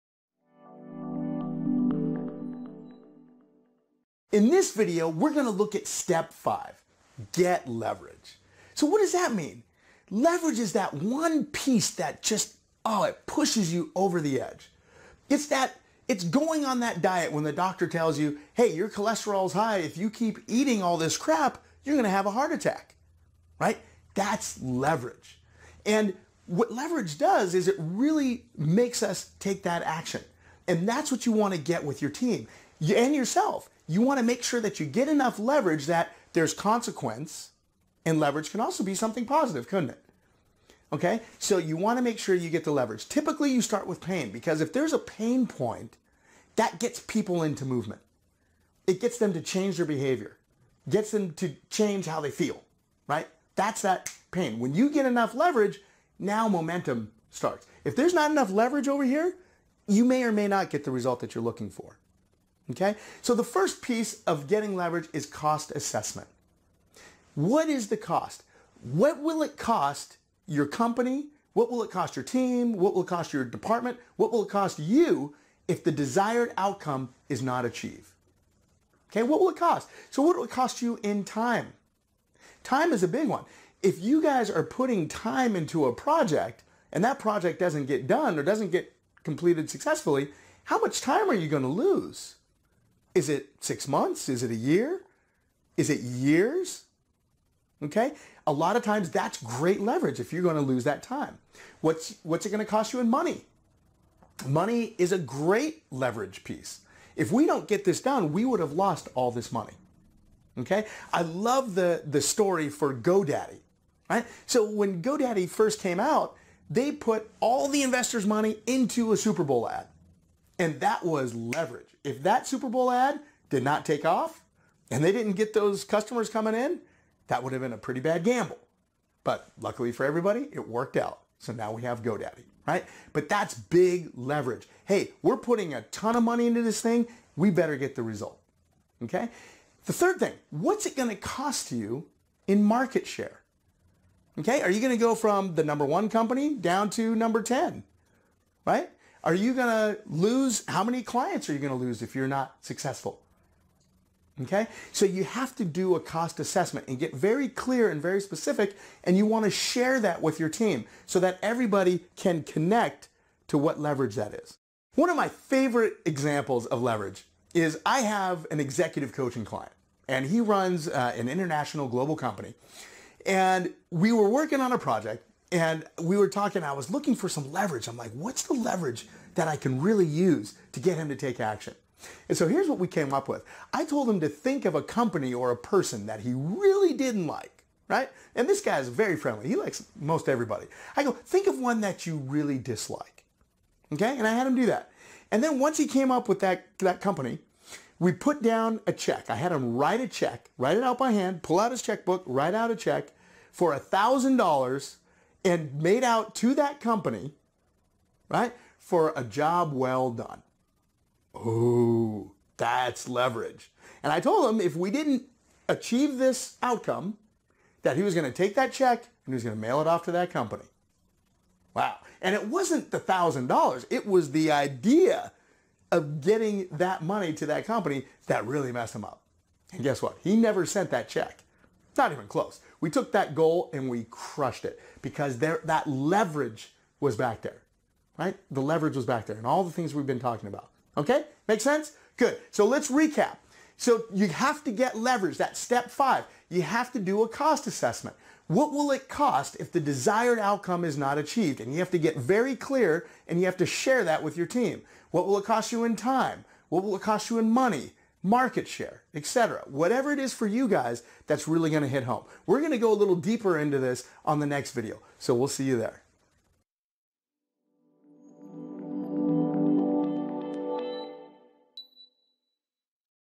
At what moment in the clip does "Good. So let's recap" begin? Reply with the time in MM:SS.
04:02.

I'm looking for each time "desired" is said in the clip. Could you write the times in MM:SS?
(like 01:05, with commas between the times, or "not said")
01:15, 04:09.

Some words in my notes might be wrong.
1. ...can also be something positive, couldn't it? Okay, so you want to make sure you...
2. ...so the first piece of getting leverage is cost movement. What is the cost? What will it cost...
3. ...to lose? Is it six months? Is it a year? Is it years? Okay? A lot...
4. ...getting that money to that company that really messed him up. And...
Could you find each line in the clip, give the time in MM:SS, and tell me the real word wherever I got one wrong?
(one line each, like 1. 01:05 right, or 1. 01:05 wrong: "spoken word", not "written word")
1. 00:38 right
2. 01:03 wrong: "assessment", not "movement"
3. 01:31 right
4. 03:46 right.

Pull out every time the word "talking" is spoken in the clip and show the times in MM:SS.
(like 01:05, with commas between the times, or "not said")
02:56, 04:00.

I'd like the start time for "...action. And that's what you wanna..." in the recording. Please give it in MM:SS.
00:29.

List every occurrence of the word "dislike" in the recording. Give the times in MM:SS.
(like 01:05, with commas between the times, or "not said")
03:12.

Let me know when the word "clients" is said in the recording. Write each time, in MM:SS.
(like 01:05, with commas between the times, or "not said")
02:31, 02:49.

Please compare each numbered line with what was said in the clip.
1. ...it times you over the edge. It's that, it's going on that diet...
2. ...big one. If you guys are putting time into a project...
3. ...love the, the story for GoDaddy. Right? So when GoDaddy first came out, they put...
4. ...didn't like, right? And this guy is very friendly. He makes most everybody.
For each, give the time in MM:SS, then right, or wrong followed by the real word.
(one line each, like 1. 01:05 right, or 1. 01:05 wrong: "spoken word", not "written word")
1. 00:13 wrong: "pushes", not "times"
2. 01:23 right
3. 01:51 right
4. 03:06 wrong: "likes", not "makes".